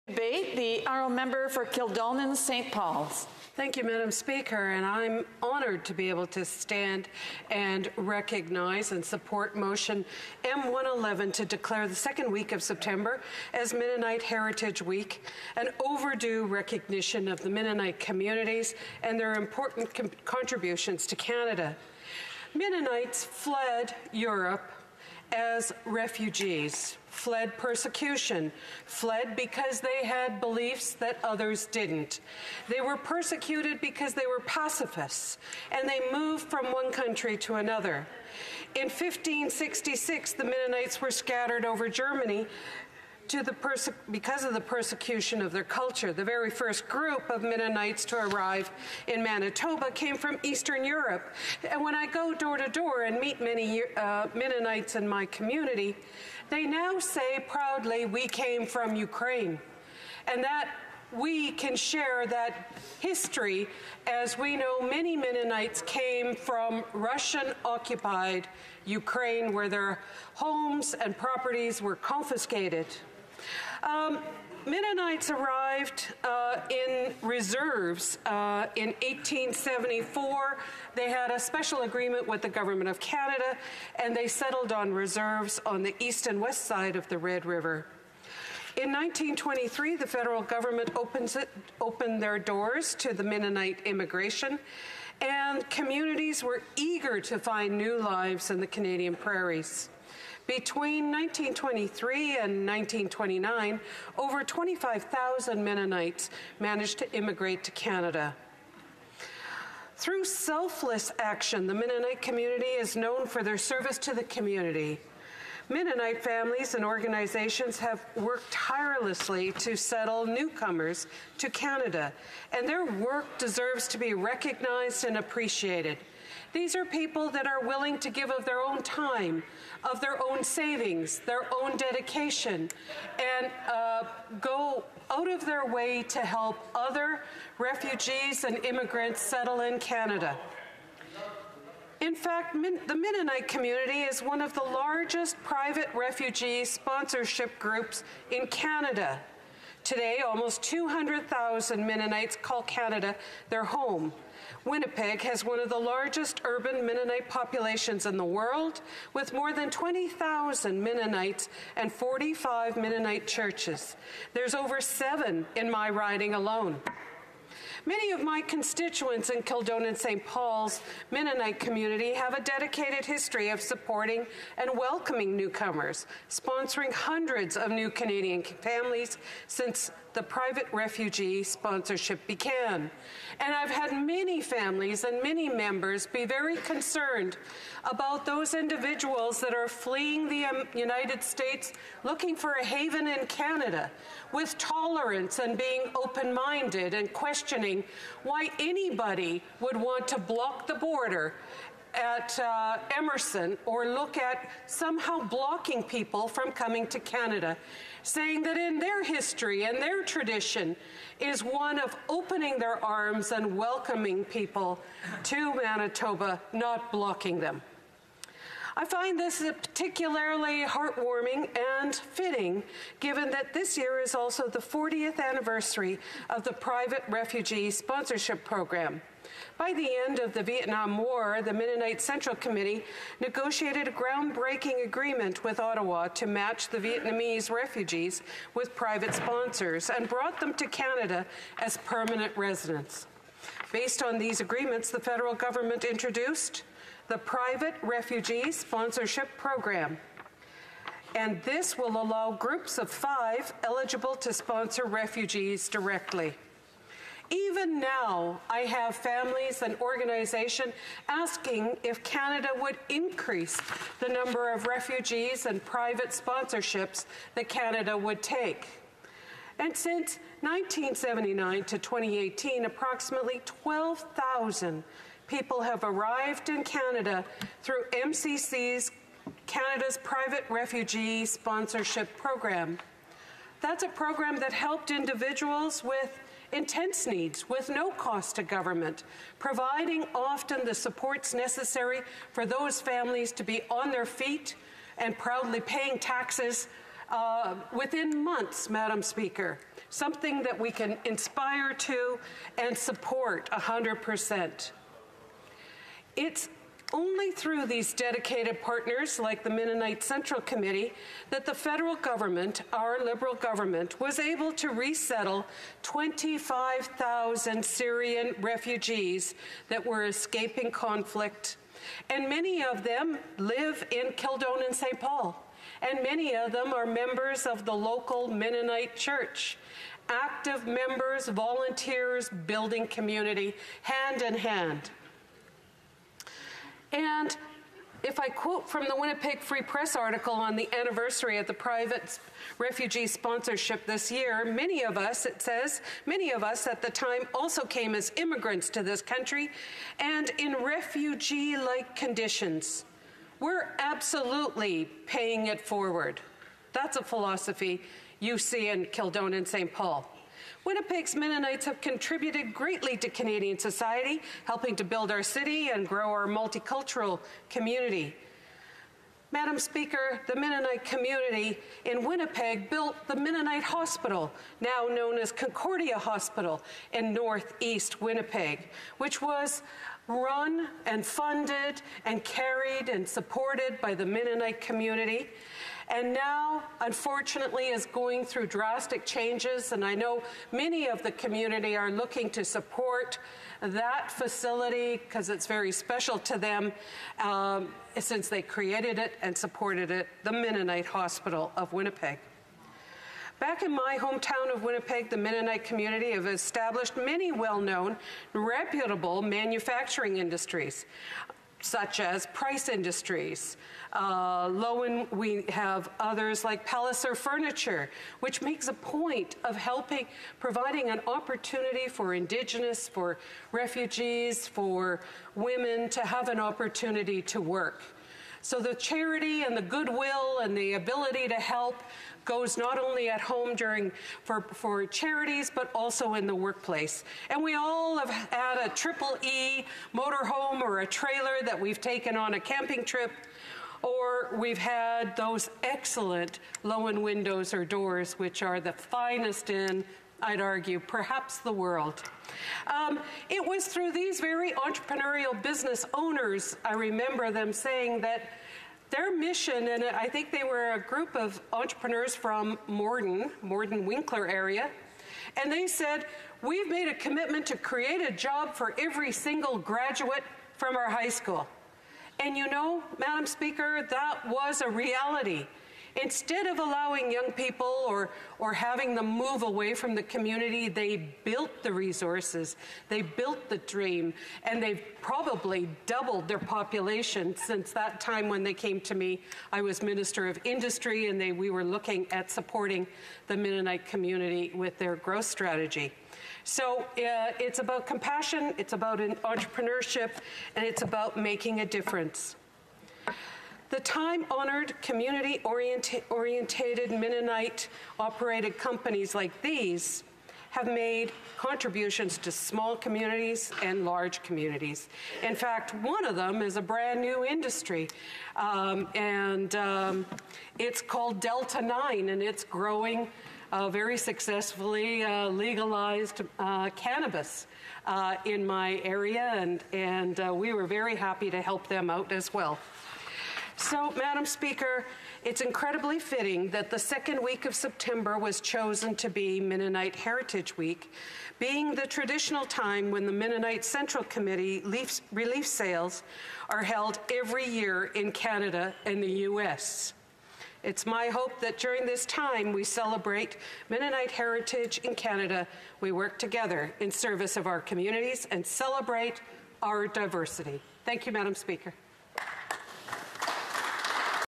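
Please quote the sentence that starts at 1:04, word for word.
As we know, many Mennonites came from Russian occupied Ukraine, where their homes and properties were confiscated.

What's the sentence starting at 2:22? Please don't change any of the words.
In fact, Min the Mennonite community is one of the largest private refugee sponsorship groups in Canada.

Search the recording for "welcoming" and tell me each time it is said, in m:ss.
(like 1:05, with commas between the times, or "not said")
2:54, 3:33.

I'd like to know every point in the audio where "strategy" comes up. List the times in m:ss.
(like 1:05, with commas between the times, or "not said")
8:15.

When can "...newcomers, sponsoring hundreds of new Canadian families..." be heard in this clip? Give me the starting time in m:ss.
2:55.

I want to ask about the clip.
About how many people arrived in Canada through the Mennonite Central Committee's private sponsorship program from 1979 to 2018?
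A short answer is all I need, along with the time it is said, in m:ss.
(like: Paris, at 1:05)
12,000, at 4:33.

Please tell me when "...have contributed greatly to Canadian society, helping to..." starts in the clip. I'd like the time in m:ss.
6:01.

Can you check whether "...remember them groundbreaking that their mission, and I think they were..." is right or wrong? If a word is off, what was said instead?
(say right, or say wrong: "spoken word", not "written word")
wrong: "saying", not "groundbreaking".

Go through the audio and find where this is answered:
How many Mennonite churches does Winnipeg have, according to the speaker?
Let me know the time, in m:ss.
2:41.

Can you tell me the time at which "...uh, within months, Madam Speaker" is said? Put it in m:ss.
4:57.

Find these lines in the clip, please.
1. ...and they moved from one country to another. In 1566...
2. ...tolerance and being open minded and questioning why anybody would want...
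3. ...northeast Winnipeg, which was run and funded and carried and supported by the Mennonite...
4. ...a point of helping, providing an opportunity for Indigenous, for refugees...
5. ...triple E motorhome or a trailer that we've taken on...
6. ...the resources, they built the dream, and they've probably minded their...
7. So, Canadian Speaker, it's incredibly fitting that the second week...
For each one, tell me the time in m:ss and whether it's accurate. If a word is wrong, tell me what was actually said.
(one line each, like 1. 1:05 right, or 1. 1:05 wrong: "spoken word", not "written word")
1. 0:35 right
2. 3:14 right
3. 6:17 right
4. 6:58 right
5. 7:18 right
6. 8:01 wrong: "doubled", not "minded"
7. 8:53 wrong: "Madam", not "Canadian".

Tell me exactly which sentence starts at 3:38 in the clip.
I find this particularly heartwarming and fitting, given that this year is also the 40th anniversary of the Private Refugee Sponsorship Program.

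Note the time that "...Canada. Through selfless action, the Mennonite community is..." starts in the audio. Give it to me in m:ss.
1:47.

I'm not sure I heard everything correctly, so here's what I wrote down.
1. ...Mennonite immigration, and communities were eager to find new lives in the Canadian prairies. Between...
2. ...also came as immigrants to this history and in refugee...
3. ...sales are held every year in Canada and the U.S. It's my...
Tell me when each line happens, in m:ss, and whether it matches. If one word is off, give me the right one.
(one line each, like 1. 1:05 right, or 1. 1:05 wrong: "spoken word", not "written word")
1. 1:33 right
2. 5:47 wrong: "country", not "history"
3. 9:05 right.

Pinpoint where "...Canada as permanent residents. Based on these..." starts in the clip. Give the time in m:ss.
4:00.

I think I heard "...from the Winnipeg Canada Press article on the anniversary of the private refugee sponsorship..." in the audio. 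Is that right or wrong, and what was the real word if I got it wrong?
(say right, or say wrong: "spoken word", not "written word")
wrong: "Free", not "Canada".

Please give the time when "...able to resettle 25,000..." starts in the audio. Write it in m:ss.
5:14.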